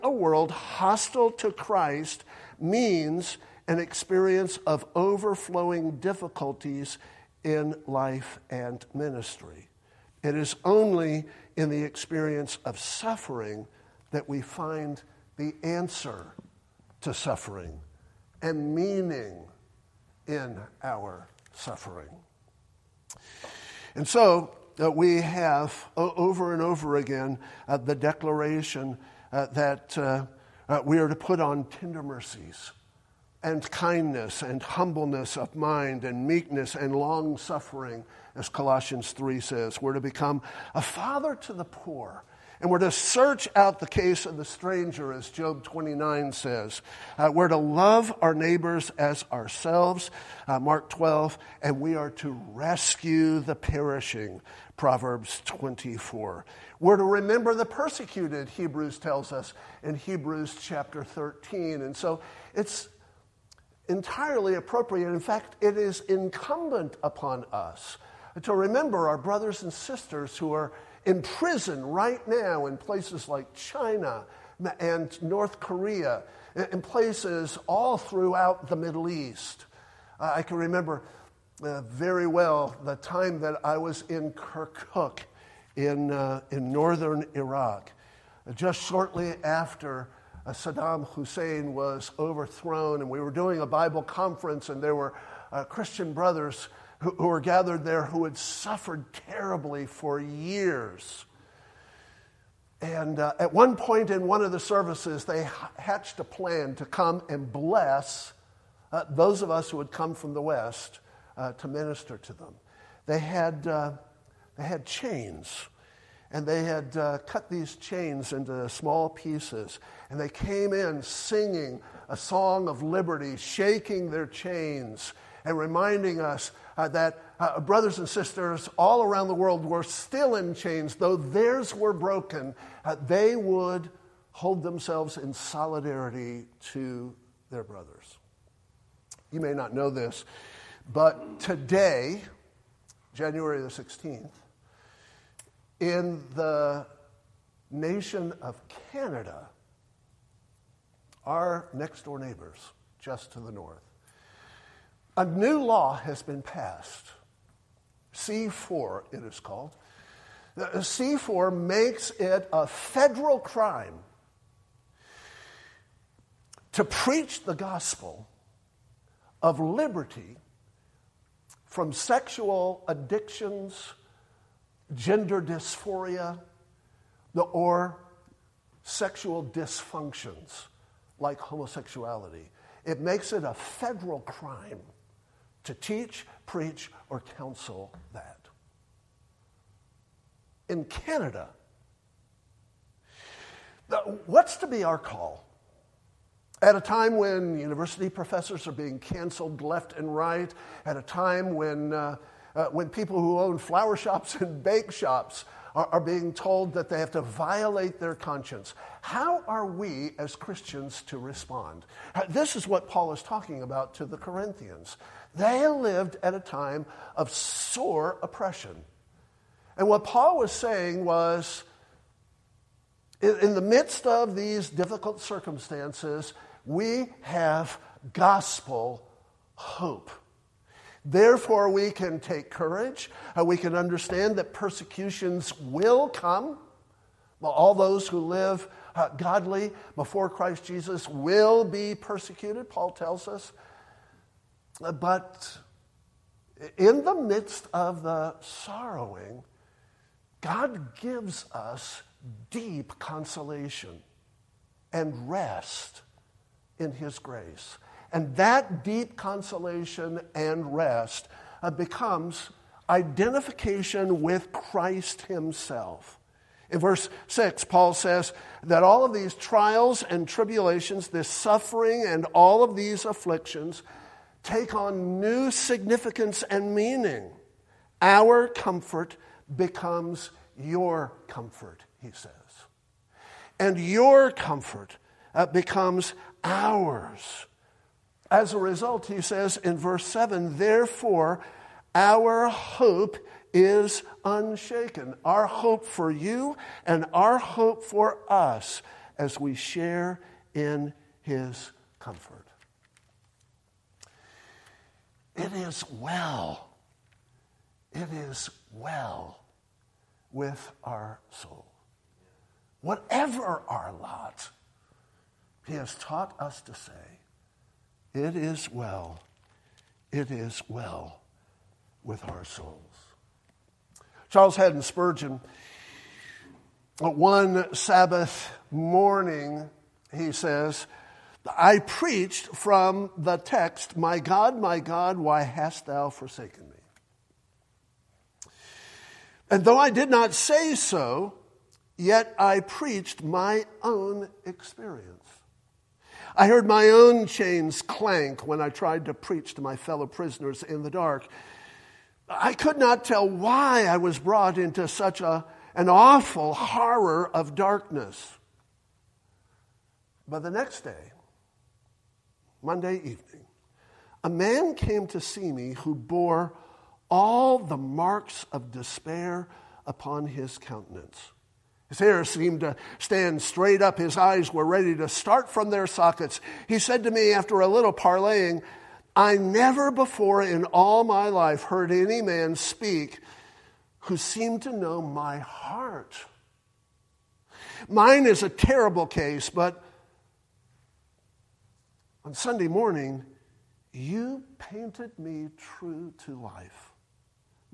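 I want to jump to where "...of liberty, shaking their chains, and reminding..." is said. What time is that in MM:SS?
02:02.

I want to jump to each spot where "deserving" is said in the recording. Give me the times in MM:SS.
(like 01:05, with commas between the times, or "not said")
not said.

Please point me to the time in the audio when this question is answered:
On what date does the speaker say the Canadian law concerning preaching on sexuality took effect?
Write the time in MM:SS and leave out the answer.
02:23.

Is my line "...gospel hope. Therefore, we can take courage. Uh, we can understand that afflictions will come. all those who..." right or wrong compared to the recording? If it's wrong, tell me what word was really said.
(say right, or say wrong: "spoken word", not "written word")
wrong: "persecutions", not "afflictions".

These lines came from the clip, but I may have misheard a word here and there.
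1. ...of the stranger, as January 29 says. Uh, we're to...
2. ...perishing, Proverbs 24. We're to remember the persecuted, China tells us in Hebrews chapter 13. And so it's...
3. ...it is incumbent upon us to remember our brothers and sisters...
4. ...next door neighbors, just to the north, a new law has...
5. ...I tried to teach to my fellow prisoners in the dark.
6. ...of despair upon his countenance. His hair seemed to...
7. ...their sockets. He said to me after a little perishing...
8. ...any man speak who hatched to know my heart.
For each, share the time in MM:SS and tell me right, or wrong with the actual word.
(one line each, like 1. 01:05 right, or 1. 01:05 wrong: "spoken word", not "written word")
1. 00:44 wrong: "Job", not "January"
2. 00:53 wrong: "Hebrews", not "China"
3. 01:05 right
4. 02:31 right
5. 05:48 wrong: "preach", not "teach"
6. 06:08 right
7. 06:15 wrong: "parleying", not "perishing"
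8. 06:21 wrong: "seemed", not "hatched".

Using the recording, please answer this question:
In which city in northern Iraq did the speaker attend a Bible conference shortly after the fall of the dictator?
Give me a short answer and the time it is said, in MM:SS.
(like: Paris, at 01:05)
Kirkuk, at 01:24.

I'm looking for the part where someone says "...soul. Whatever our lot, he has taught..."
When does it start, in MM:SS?
05:11.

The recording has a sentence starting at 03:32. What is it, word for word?
Uh, this is what Paul is talking about to the Corinthians.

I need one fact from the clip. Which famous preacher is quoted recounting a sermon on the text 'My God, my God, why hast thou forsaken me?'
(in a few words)
Charles Haddon Spurgeon.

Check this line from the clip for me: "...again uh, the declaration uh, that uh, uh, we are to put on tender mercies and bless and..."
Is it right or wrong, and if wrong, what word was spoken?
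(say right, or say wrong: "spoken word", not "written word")
wrong: "kindness", not "bless".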